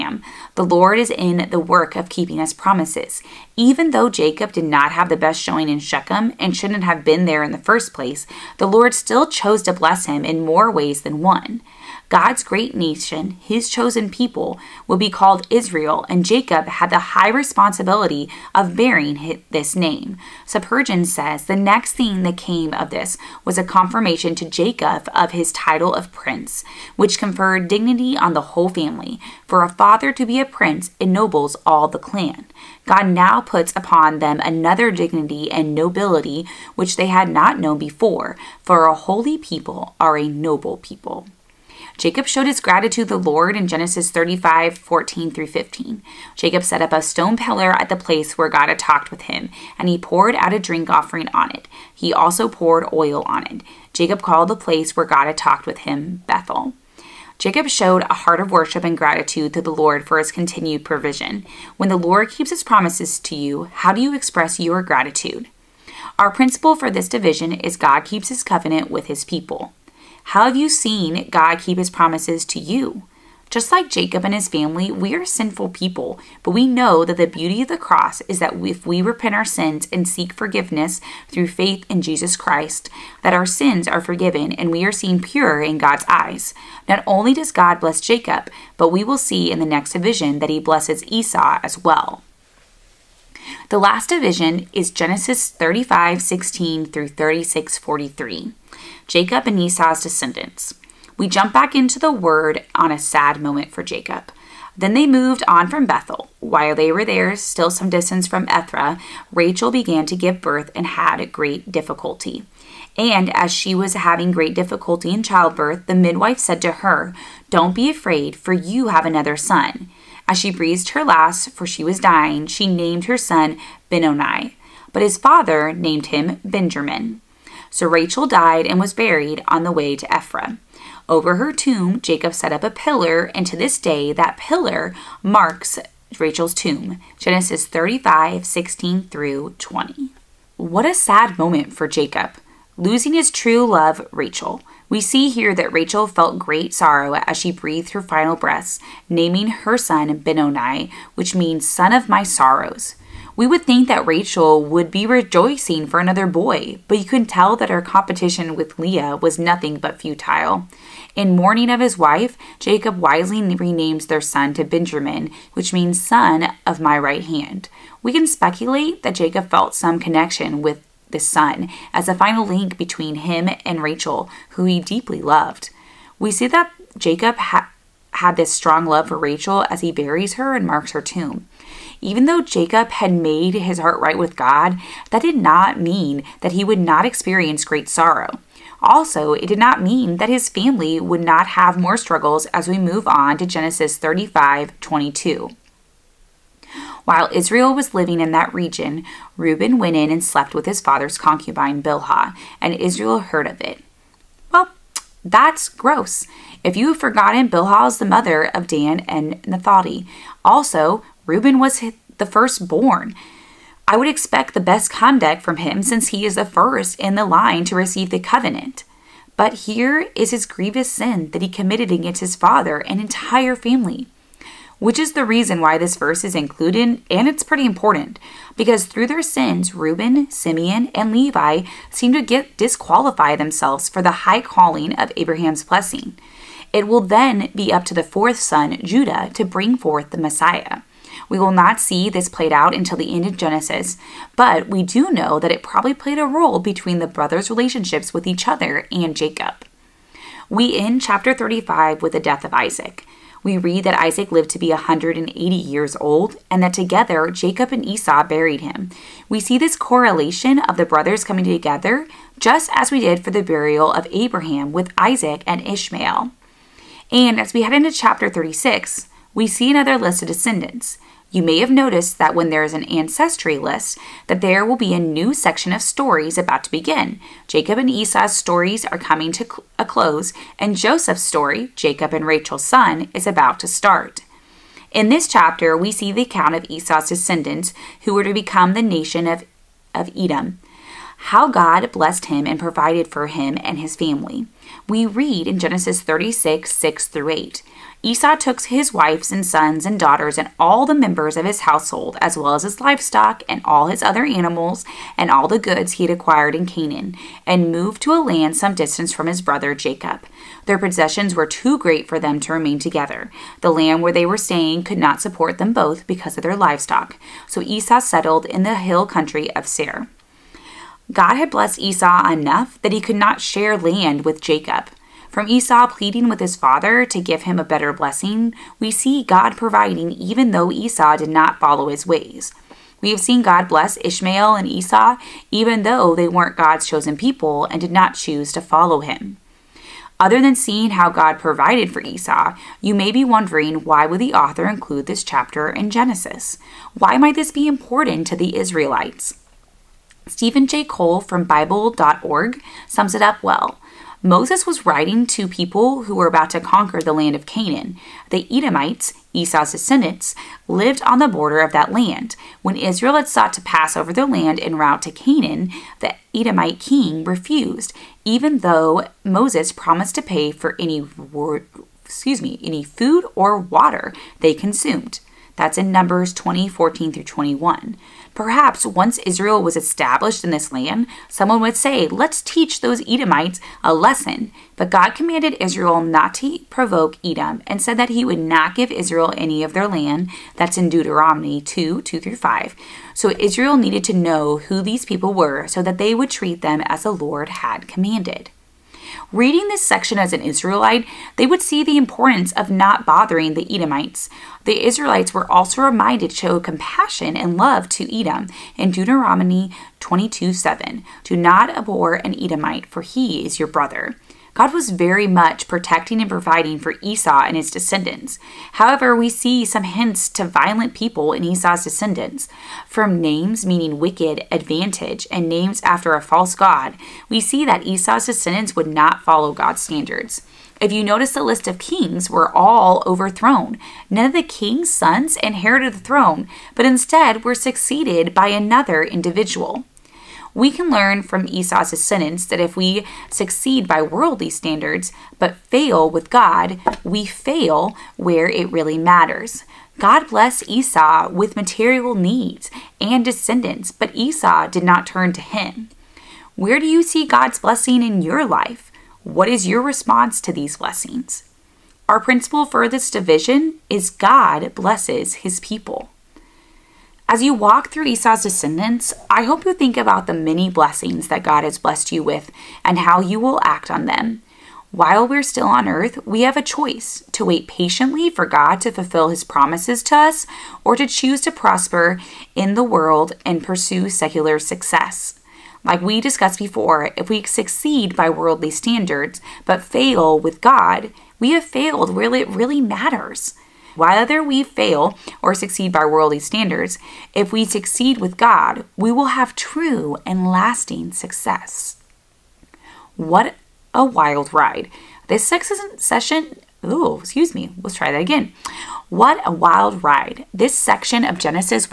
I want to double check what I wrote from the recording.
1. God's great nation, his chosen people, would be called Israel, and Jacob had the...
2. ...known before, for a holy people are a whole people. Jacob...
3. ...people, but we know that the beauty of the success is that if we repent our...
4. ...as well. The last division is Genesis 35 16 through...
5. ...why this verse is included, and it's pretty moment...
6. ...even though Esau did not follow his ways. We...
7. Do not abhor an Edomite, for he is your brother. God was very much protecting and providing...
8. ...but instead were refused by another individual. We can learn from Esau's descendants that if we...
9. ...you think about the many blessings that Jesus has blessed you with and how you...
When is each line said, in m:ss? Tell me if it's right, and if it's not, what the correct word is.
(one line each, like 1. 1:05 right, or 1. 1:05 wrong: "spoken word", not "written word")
1. 0:12 right
2. 0:37 wrong: "noble", not "whole"
3. 1:15 wrong: "cross", not "success"
4. 1:31 right
5. 3:45 wrong: "important", not "moment"
6. 5:30 right
7. 6:51 right
8. 7:16 wrong: "succeeded", not "refused"
9. 7:49 wrong: "God", not "Jesus".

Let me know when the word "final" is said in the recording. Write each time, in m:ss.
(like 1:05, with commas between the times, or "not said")
2:28, 2:52.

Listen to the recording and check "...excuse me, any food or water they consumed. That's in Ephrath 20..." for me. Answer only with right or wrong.
wrong.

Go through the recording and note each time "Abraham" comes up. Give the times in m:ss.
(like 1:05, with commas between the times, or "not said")
3:55, 4:24.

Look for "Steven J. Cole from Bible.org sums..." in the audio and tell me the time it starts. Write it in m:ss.
5:50.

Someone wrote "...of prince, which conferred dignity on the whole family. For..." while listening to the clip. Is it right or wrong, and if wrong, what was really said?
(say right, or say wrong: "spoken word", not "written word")
right.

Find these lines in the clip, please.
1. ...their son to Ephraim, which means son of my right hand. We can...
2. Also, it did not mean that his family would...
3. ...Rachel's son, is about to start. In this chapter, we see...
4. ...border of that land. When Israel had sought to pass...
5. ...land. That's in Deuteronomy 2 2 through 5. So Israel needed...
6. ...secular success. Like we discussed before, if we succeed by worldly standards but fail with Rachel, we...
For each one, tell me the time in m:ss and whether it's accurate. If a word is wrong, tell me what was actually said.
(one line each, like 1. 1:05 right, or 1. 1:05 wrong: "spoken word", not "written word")
1. 2:44 wrong: "Benjamin", not "Ephraim"
2. 3:08 right
3. 4:42 right
4. 6:01 right
5. 6:29 right
6. 8:04 wrong: "God", not "Rachel".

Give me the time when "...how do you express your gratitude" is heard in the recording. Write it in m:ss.
1:03.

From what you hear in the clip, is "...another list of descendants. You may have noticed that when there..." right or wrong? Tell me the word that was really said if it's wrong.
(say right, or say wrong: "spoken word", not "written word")
right.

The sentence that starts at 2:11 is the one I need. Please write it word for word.
Over her tomb, Jacob set up a pillar, and to this day, that pillar marks Rachel's tomb.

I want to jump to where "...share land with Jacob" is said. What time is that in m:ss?
5:23.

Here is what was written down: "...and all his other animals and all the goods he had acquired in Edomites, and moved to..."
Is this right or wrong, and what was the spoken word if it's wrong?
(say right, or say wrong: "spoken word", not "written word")
wrong: "Canaan", not "Edomites".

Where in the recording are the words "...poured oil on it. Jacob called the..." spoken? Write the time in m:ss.
0:52.